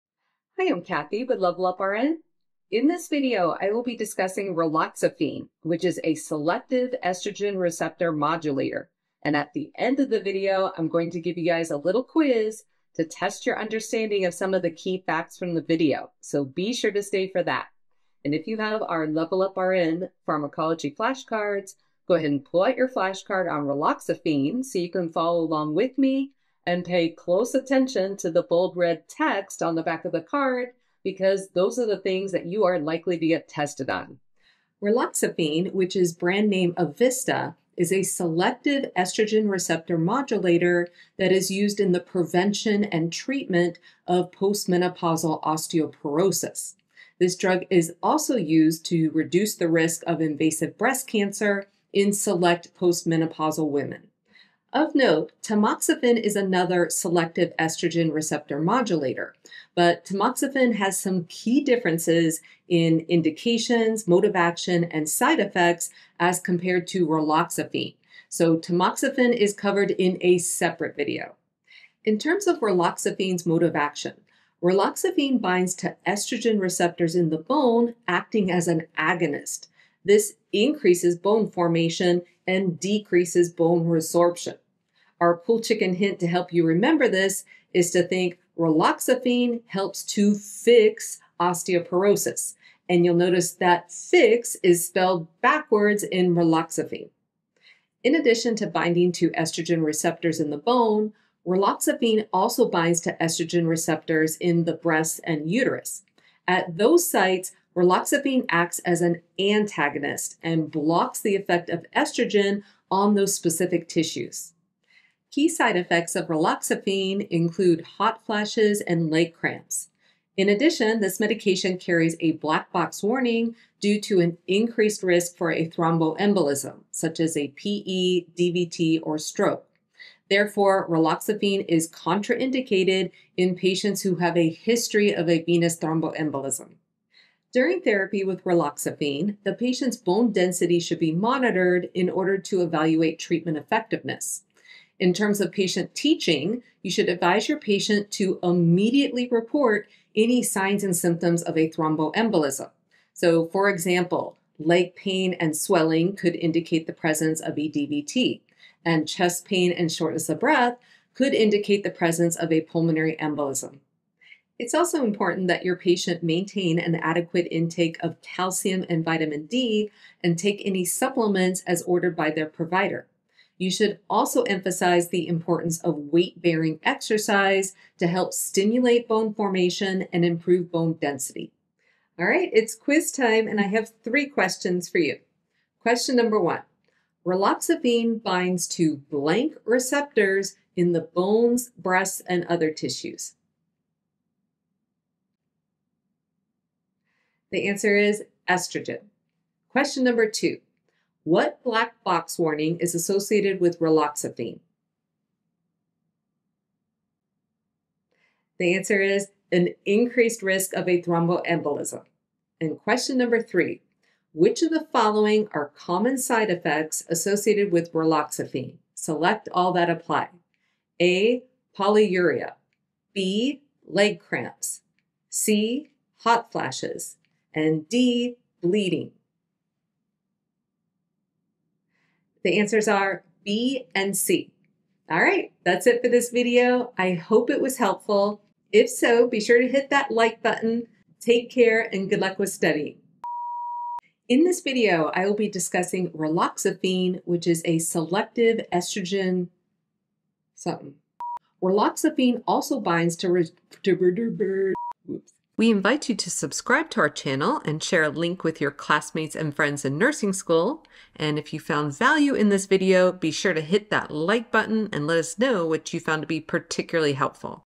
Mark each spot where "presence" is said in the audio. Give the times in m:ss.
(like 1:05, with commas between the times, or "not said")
2:36, 2:41.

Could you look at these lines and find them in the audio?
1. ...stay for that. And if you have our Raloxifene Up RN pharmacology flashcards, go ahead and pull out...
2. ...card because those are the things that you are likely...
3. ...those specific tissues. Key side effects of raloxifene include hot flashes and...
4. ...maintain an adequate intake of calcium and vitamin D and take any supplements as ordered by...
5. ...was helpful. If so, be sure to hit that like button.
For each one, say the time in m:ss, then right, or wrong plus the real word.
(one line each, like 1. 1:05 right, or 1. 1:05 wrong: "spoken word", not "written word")
1. 0:17 wrong: "Level", not "Raloxifene"
2. 0:30 right
3. 1:53 right
4. 2:46 right
5. 3:57 right.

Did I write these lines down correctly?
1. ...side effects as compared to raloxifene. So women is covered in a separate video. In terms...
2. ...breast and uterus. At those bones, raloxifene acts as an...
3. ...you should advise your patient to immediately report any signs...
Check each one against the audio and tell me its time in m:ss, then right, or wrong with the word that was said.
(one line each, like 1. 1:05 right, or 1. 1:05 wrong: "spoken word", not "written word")
1. 1:05 wrong: "tamoxifen", not "women"
2. 1:44 wrong: "sites", not "bones"
3. 2:26 right.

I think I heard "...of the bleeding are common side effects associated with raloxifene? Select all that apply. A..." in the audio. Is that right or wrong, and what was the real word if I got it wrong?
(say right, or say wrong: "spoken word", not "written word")
wrong: "following", not "bleeding".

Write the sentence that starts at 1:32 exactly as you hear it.
And you'll notice that fix is spelled backwards in raloxifene.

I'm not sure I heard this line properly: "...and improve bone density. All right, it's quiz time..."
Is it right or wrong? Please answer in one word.
right.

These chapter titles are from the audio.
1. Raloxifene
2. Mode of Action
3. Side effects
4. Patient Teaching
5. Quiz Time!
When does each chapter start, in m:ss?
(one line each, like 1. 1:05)
1. 0:34
2. 1:11
3. 1:54
4. 2:25
5. 3:01.